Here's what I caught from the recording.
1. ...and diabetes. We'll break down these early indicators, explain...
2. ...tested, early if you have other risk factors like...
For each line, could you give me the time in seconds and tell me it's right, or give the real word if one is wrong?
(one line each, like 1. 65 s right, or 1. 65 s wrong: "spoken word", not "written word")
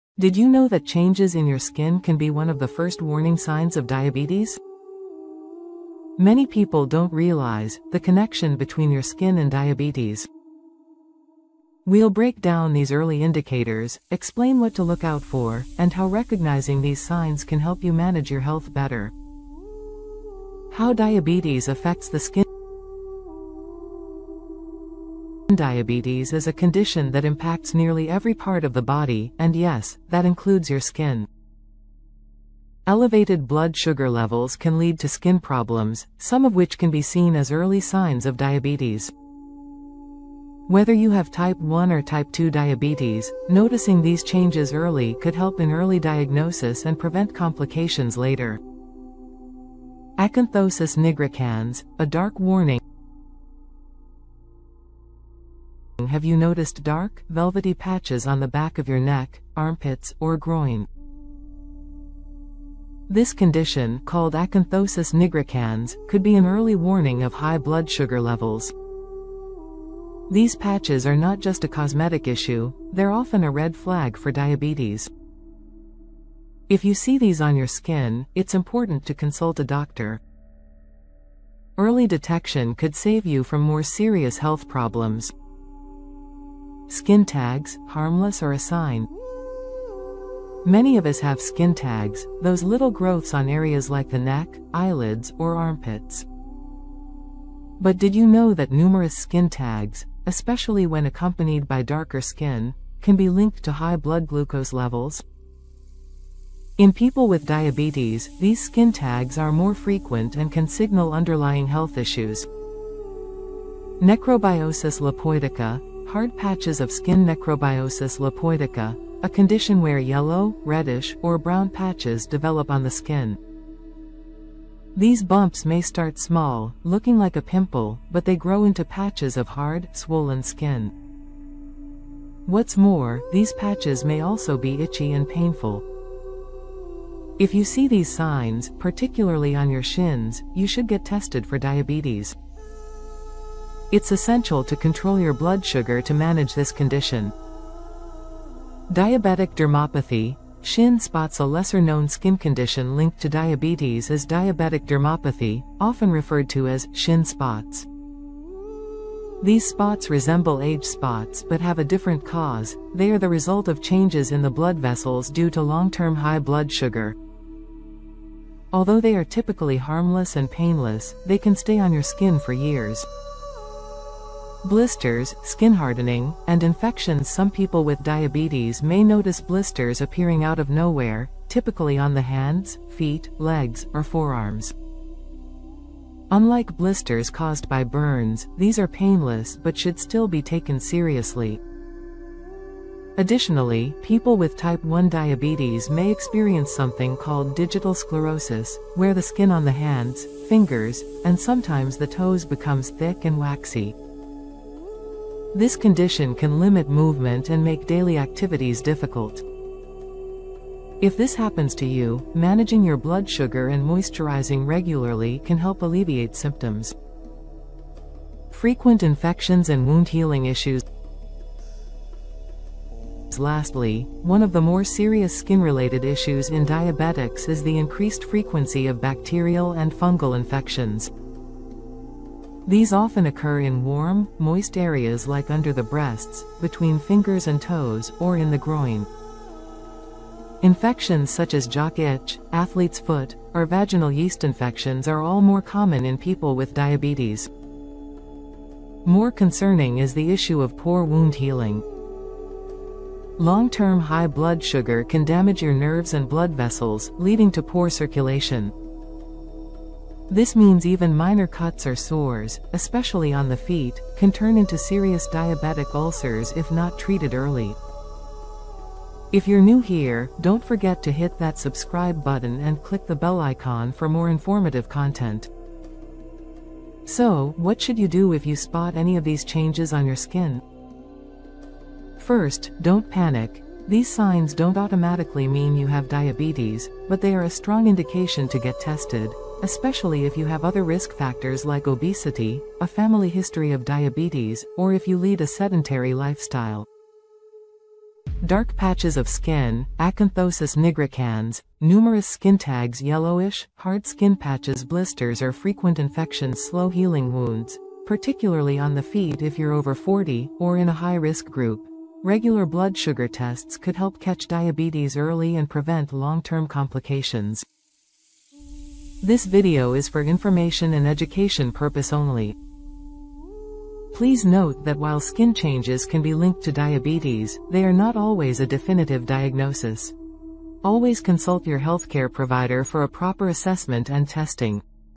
1. 9 s right
2. 288 s wrong: "especially", not "early".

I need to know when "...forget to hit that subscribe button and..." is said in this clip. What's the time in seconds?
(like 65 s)
270 s.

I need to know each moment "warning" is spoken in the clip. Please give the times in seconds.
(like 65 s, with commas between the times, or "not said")
3 s, 52 s, 66 s.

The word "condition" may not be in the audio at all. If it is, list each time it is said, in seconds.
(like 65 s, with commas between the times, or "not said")
26 s, 63 s, 119 s, 146 s, 152 s, 205 s.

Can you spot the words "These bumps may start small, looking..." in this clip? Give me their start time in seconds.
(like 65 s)
124 s.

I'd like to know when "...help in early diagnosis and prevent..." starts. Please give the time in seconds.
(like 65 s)
45 s.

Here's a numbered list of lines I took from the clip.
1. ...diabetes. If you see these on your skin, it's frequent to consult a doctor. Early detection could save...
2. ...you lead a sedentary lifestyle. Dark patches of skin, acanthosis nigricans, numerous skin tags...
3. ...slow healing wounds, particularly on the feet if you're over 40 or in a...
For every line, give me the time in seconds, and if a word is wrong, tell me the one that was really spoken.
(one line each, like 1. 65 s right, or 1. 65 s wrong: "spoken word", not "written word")
1. 74 s wrong: "important", not "frequent"
2. 295 s right
3. 306 s right.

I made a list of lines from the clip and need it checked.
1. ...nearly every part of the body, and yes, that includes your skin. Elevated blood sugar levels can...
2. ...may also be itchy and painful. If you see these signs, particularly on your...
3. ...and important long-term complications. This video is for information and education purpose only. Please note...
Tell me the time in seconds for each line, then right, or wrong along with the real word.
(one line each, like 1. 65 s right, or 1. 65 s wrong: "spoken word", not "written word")
1. 27 s right
2. 134 s right
3. 315 s wrong: "prevent", not "important".